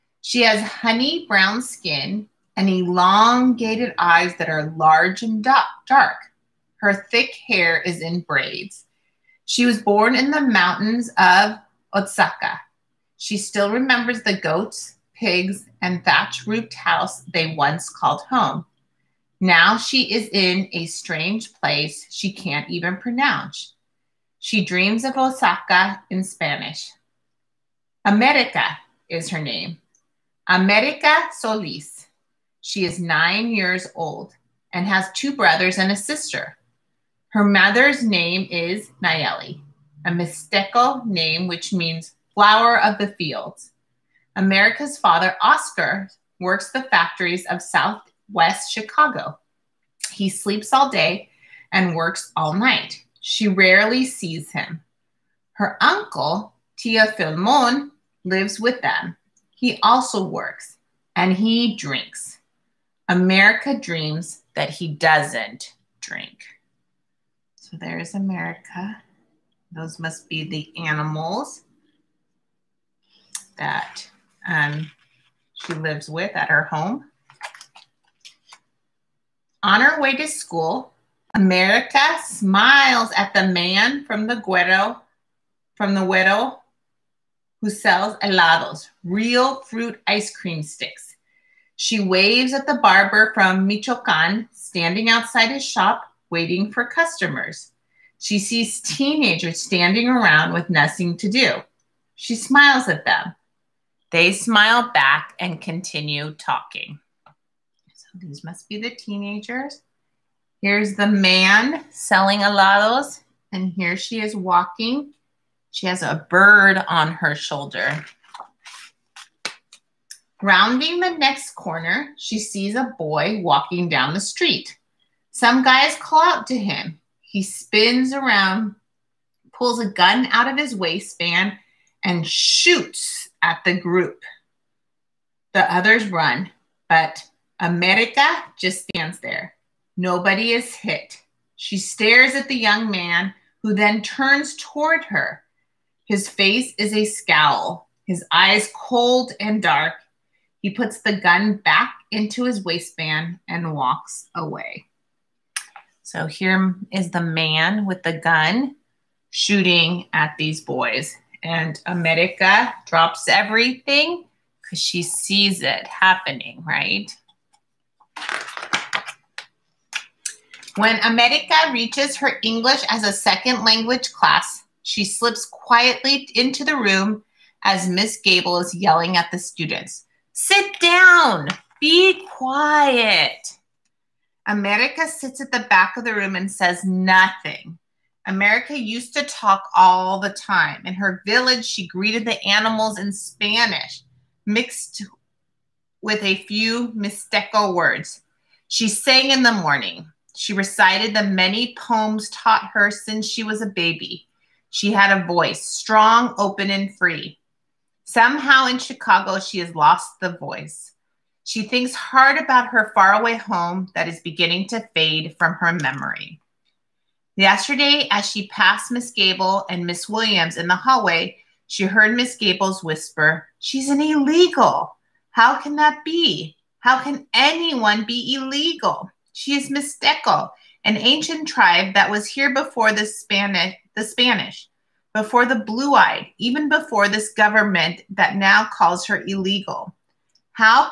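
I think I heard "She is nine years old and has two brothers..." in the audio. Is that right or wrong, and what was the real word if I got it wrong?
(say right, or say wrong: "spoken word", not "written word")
right.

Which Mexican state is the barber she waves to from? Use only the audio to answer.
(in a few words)
Michoacan.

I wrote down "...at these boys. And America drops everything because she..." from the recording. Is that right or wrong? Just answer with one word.
right.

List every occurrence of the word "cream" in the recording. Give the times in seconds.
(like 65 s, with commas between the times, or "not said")
90 s.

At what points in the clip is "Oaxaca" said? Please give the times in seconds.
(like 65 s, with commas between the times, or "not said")
11 s, 25 s.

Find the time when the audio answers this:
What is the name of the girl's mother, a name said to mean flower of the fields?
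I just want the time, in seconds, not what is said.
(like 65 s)
39 s.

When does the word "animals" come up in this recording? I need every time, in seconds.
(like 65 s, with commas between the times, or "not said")
70 s, 192 s.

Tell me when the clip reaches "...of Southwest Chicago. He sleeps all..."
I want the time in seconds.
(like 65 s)
47 s.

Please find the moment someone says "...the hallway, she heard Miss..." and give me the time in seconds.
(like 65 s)
220 s.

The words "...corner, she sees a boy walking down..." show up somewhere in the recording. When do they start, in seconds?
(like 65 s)
121 s.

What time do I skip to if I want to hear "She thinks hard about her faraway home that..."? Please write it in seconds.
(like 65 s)
211 s.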